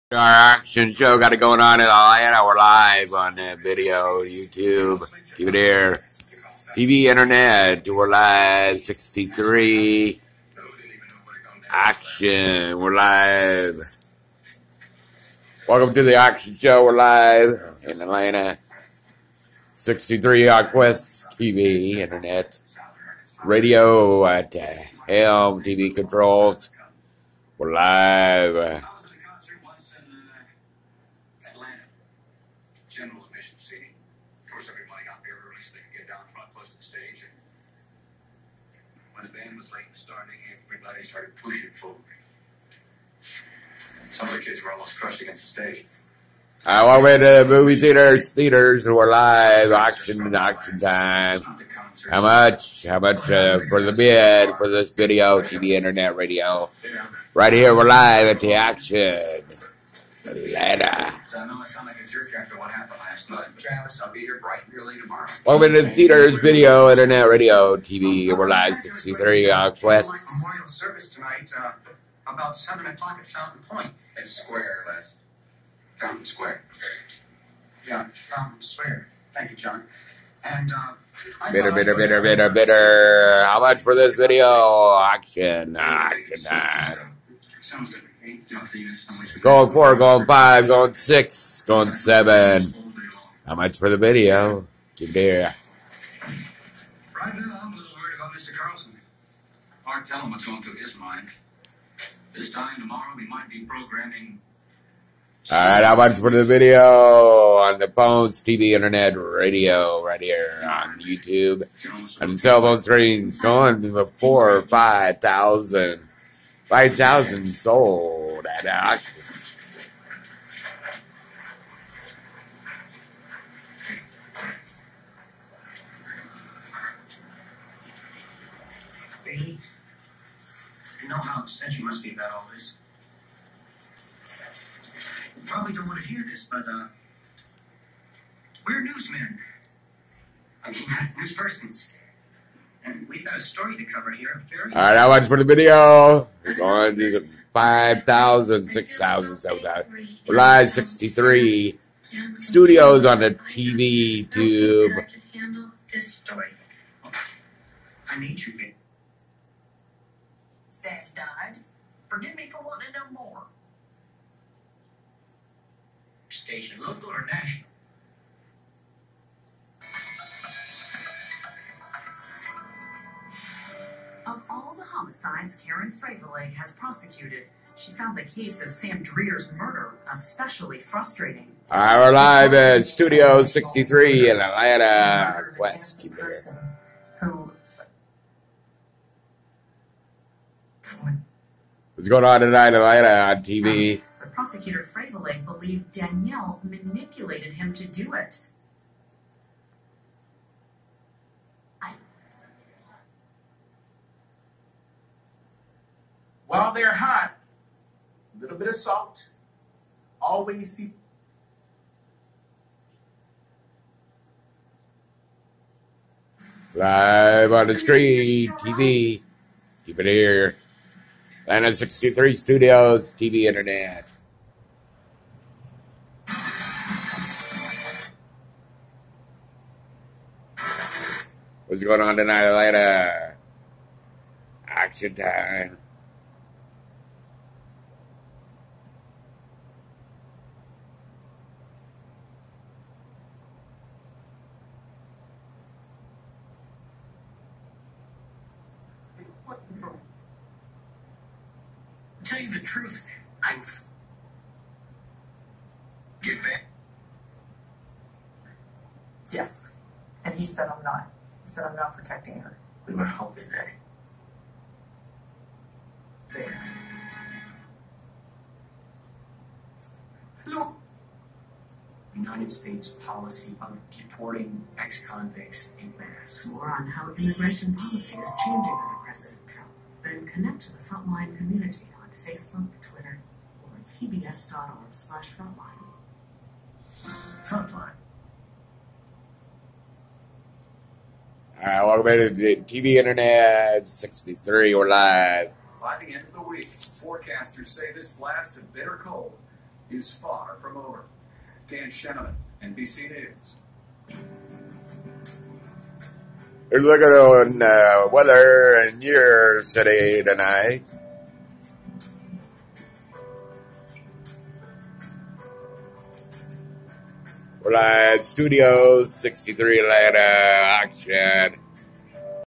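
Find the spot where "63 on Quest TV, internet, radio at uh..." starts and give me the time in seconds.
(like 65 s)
19 s.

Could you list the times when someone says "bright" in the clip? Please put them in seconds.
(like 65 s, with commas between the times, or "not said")
64 s.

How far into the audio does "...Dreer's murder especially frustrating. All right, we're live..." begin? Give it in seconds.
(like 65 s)
179 s.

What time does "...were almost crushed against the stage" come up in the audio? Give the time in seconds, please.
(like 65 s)
44 s.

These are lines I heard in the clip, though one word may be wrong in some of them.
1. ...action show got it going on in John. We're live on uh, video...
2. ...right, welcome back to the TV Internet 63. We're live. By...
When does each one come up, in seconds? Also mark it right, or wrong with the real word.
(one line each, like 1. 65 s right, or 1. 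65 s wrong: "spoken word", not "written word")
1. 0 s wrong: "Atlanta", not "John"
2. 291 s right.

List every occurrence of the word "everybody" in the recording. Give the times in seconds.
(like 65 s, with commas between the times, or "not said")
34 s, 40 s.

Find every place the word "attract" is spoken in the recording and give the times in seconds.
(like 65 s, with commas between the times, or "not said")
not said.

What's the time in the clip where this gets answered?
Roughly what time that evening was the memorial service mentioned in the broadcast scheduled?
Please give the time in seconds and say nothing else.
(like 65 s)
72 s.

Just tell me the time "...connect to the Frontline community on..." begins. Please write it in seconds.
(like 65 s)
280 s.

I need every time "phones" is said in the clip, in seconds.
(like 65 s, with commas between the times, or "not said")
107 s, 112 s.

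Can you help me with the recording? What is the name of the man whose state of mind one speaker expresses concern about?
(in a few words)
Mr. Carlson.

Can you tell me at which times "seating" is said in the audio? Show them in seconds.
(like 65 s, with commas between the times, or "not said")
33 s.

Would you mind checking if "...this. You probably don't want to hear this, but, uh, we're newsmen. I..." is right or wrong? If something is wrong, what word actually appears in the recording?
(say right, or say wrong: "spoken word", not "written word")
right.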